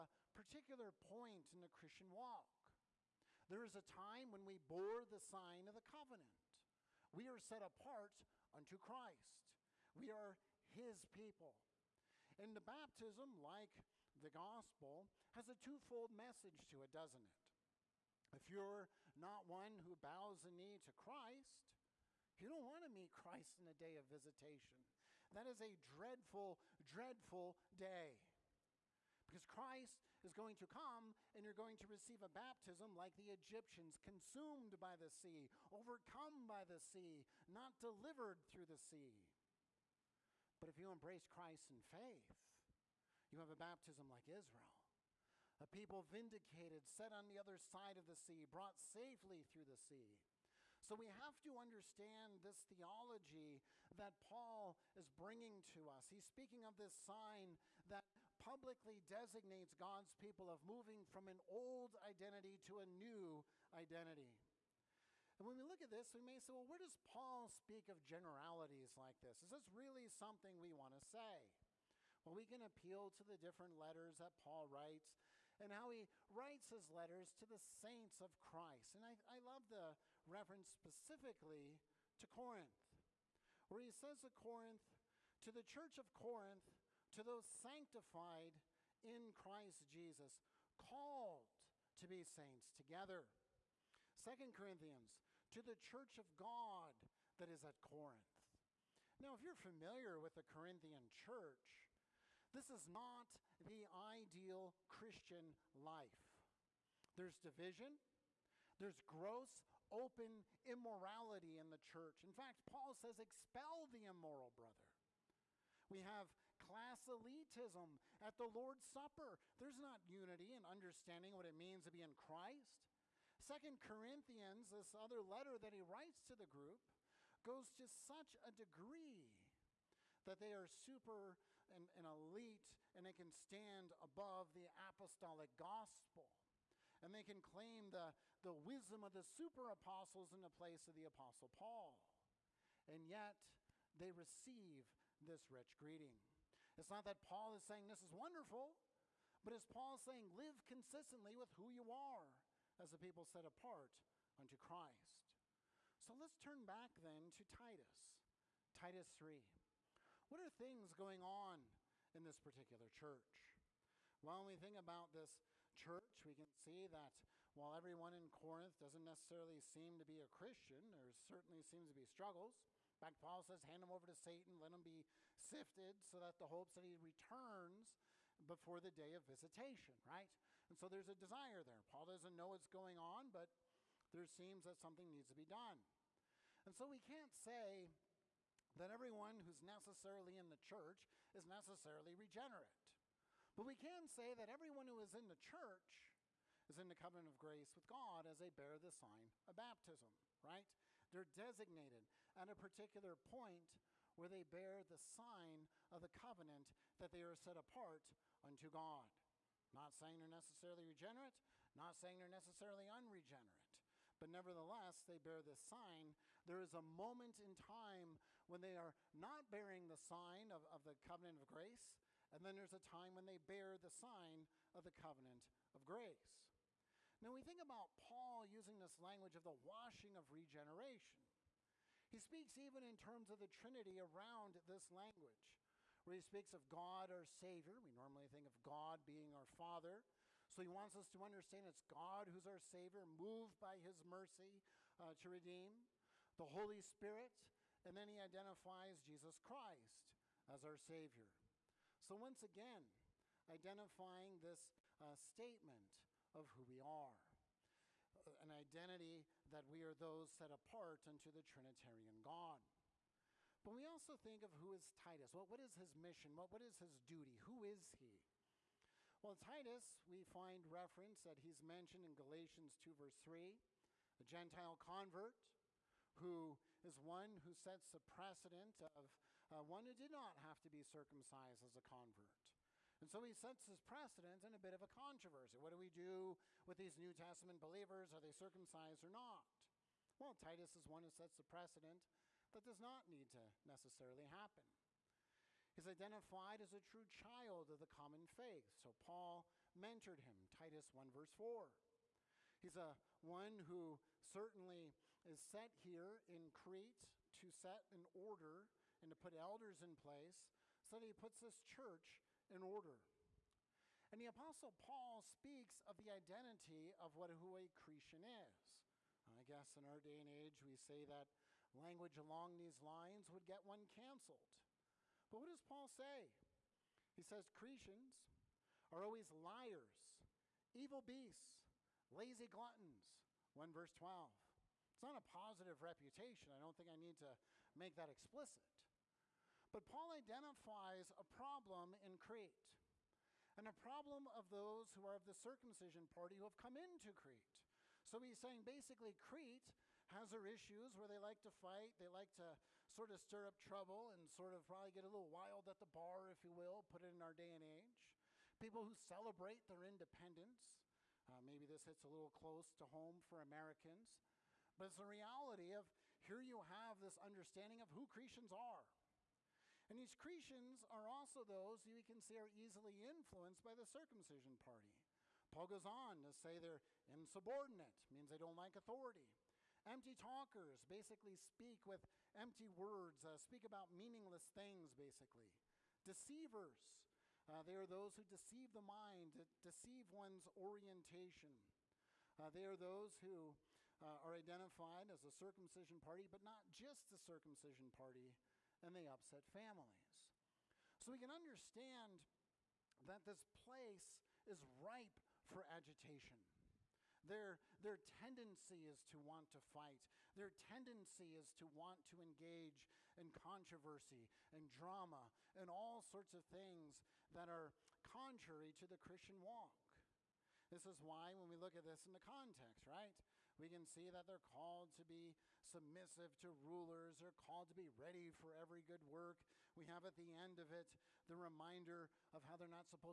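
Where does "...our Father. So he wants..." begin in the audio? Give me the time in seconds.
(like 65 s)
239 s.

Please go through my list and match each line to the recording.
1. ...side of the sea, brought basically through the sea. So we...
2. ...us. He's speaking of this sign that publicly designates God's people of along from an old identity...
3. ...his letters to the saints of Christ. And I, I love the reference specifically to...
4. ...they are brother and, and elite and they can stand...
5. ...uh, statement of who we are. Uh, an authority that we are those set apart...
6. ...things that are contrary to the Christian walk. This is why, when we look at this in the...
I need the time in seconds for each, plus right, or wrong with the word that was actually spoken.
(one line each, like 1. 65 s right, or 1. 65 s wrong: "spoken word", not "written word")
1. 47 s wrong: "safely", not "basically"
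2. 55 s wrong: "moving", not "along"
3. 76 s right
4. 130 s wrong: "super", not "brother"
5. 254 s wrong: "identity", not "authority"
6. 416 s right.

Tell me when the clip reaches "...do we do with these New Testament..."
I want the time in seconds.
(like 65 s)
285 s.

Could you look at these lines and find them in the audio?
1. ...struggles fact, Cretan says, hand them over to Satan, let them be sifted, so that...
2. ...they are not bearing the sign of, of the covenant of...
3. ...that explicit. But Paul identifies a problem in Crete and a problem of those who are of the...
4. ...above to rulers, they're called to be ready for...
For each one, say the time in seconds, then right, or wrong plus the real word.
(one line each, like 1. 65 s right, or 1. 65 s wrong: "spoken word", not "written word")
1. 172 s wrong: "Paul", not "Cretan"
2. 218 s right
3. 337 s right
4. 425 s wrong: "submissive", not "above".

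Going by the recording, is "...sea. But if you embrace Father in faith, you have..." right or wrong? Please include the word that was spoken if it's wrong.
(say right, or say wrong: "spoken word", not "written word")
wrong: "Christ", not "Father".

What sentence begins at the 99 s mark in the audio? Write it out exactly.
Now, if you're familiar with the Corinthian church, this is not the ideal Christian life.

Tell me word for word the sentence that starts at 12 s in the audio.
And the baptism, like the gospel, has a twofold message to it, doesn't it?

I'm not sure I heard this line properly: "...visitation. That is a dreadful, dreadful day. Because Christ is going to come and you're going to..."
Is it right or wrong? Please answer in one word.
right.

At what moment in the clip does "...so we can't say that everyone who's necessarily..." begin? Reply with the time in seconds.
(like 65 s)
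186 s.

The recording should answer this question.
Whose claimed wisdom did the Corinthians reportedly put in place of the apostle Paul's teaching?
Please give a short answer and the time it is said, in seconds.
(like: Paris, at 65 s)
The super apostles, at 139 s.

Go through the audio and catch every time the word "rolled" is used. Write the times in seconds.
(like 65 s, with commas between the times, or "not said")
not said.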